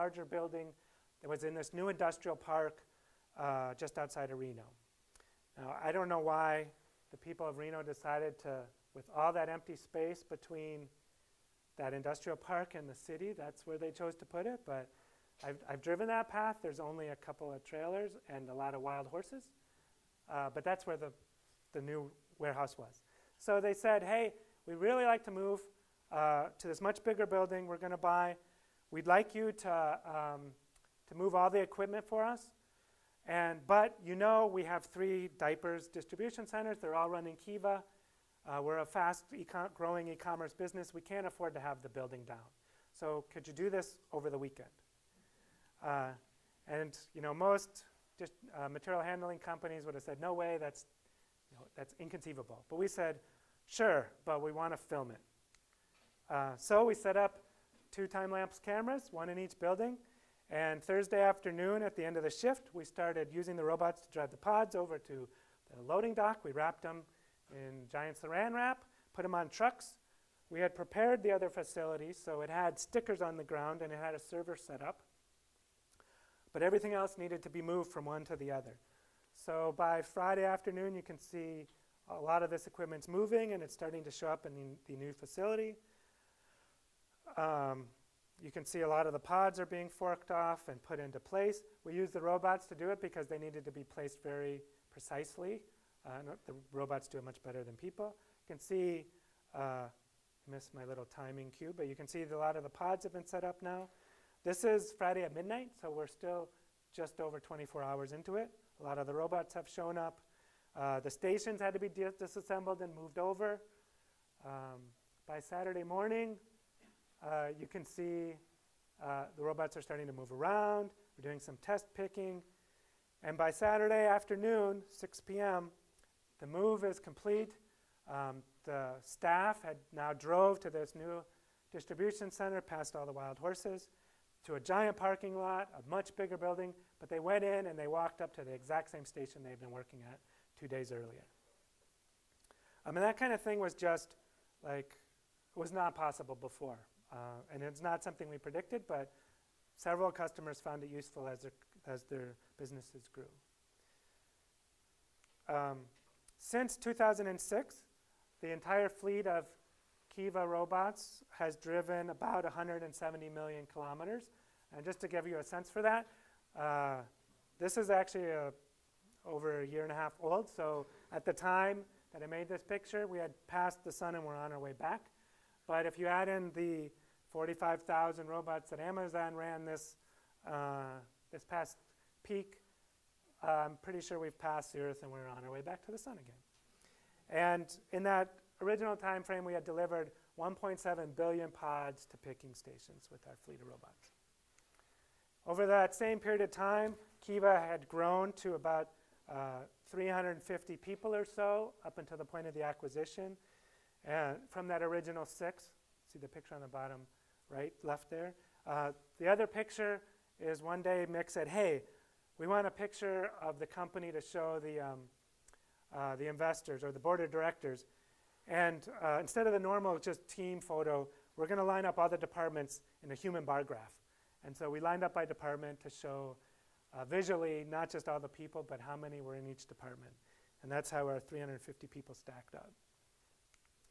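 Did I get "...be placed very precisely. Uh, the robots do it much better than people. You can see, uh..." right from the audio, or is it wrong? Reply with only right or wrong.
right.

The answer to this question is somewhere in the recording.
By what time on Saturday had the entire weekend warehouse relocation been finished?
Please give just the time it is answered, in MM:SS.
02:04.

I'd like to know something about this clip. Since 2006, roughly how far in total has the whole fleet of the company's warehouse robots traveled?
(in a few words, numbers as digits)
170 million kilometers.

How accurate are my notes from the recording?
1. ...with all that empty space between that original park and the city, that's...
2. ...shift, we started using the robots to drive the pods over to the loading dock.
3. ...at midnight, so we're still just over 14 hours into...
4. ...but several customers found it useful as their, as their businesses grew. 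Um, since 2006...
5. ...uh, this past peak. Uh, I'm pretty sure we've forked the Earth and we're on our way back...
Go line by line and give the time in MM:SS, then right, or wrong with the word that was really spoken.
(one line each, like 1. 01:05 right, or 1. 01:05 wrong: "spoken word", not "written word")
1. 00:08 wrong: "industrial", not "original"
2. 01:02 right
3. 01:45 wrong: "24", not "14"
4. 02:28 right
5. 03:00 wrong: "passed", not "forked".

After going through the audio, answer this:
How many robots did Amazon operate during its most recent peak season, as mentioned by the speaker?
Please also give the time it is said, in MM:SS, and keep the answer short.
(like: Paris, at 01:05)
45,000, at 02:57.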